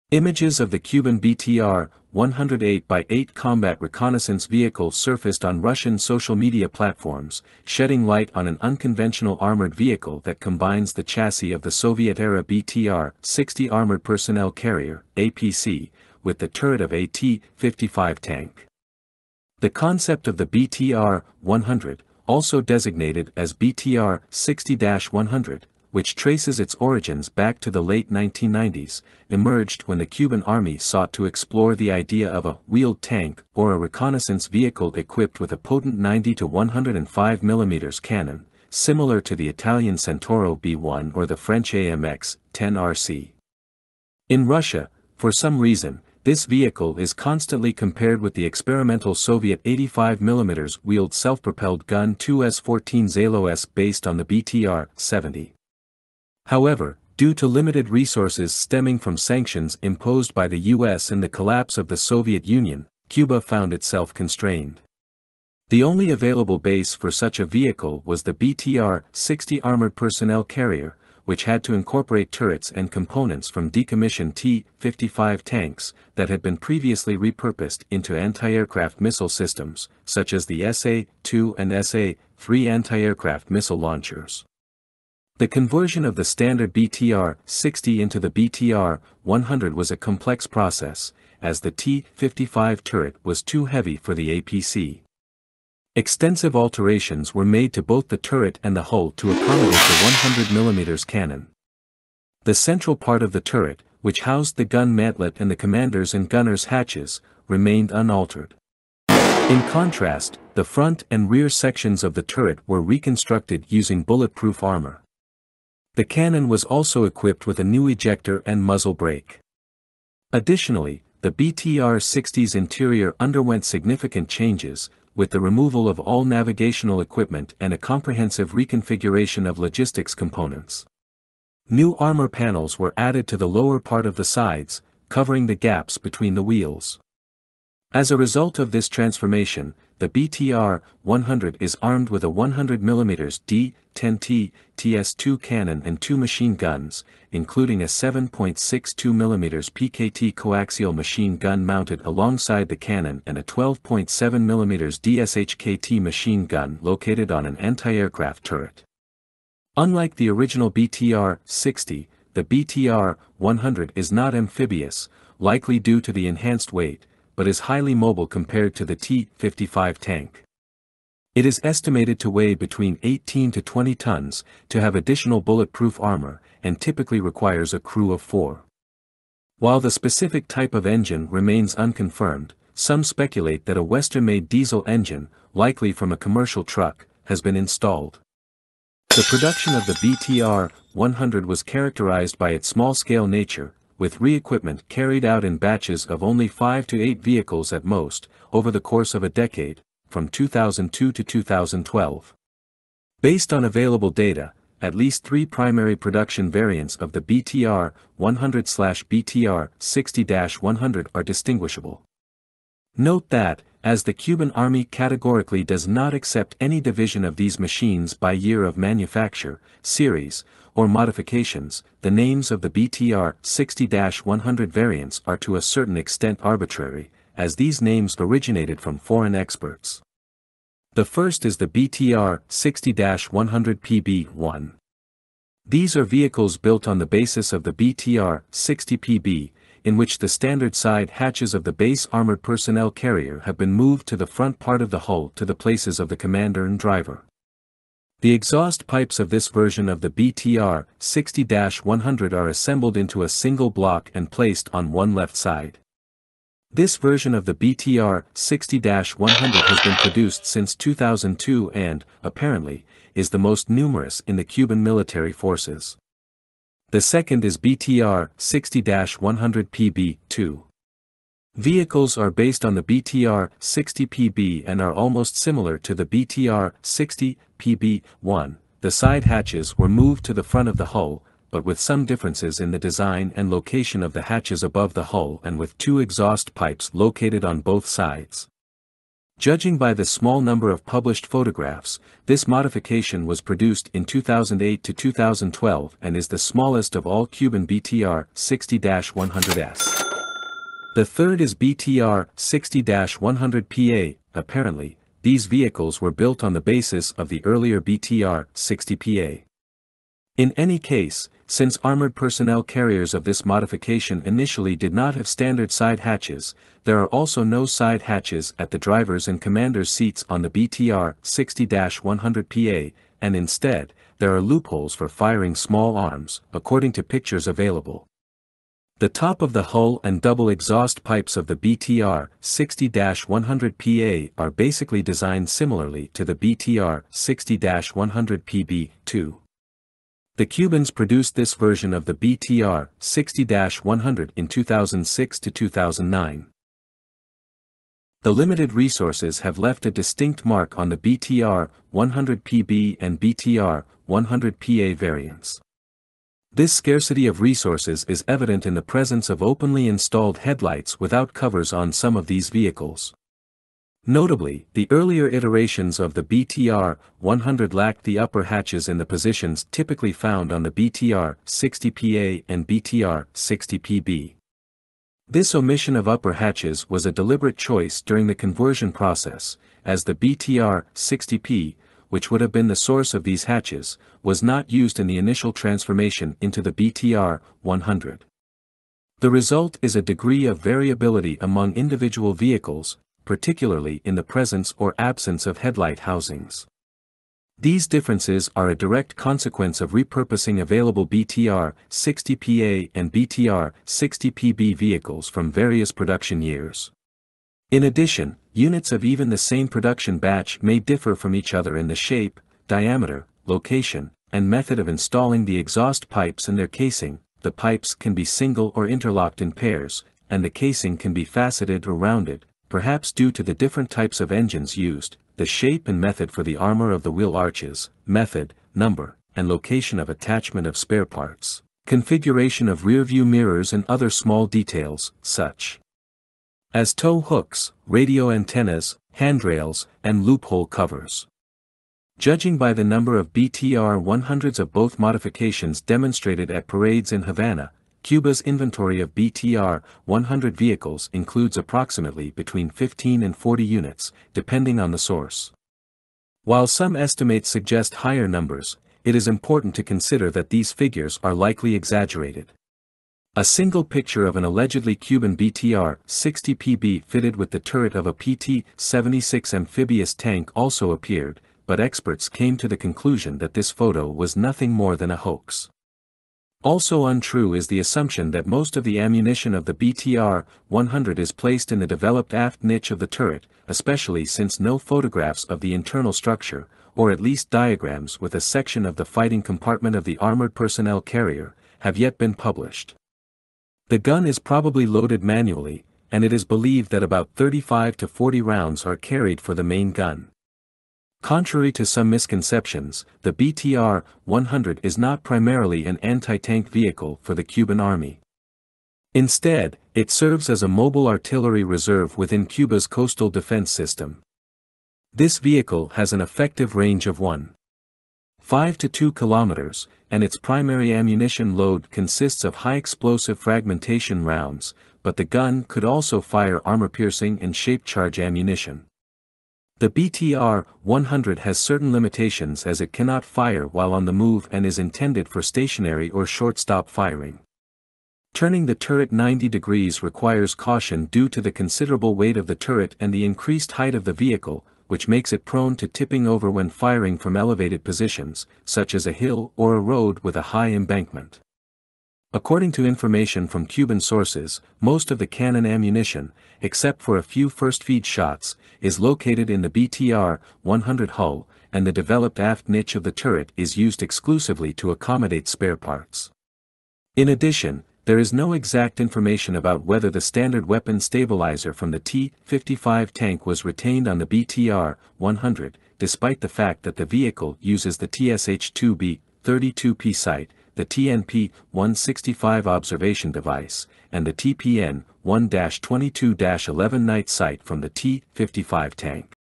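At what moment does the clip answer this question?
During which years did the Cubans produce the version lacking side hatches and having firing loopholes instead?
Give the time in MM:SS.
05:44.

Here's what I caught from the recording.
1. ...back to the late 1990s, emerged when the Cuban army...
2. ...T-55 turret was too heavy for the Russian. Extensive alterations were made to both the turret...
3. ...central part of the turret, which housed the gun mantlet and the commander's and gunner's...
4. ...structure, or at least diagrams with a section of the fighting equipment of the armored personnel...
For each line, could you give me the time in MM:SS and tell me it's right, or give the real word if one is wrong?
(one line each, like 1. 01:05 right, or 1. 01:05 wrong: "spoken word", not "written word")
1. 00:27 right
2. 01:31 wrong: "APC", not "Russian"
3. 01:42 right
4. 08:06 wrong: "compartment", not "equipment".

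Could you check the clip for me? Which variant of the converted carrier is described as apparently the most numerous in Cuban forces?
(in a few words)
BTR 60-100 PB1.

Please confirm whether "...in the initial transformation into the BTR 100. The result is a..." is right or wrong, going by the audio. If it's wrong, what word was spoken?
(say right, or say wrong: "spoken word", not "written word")
right.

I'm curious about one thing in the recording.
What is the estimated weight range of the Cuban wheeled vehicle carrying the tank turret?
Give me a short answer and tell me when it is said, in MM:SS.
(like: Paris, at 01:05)
18 to 20 tons, at 02:53.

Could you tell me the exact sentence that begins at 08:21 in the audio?
Contrary to some misconceptions, the BTR-100 is not primarily an anti-tank vehicle for the Cuban army.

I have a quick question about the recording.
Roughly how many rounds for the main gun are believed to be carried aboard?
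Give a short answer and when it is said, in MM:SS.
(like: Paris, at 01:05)
35 to 40, at 08:17.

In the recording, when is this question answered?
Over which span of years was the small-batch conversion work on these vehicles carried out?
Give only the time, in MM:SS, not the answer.
03:20.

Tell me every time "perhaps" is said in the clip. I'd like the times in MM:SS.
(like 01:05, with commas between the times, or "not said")
07:02.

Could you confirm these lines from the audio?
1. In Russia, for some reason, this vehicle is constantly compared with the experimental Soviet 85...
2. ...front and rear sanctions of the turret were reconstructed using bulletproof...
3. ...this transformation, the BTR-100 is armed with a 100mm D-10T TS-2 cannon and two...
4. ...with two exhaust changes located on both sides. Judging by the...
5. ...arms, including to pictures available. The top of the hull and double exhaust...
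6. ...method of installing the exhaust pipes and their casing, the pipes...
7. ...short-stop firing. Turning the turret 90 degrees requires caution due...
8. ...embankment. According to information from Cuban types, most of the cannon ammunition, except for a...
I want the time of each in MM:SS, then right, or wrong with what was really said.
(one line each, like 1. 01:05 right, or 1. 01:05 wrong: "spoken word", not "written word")
1. 00:44 right
2. 01:50 wrong: "sections", not "sanctions"
3. 02:18 right
4. 04:45 wrong: "pipes", not "changes"
5. 05:25 wrong: "according", not "including"
6. 06:54 right
7. 08:56 right
8. 09:10 wrong: "sources", not "types".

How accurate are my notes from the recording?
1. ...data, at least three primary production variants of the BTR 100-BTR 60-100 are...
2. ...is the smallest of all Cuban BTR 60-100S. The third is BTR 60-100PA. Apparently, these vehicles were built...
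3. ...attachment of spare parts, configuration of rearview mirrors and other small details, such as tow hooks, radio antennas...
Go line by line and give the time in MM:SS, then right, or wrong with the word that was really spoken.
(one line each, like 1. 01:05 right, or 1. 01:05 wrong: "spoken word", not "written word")
1. 03:24 right
2. 04:56 right
3. 07:10 right.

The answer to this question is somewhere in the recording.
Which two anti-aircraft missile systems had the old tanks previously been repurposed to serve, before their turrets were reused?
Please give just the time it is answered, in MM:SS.
01:20.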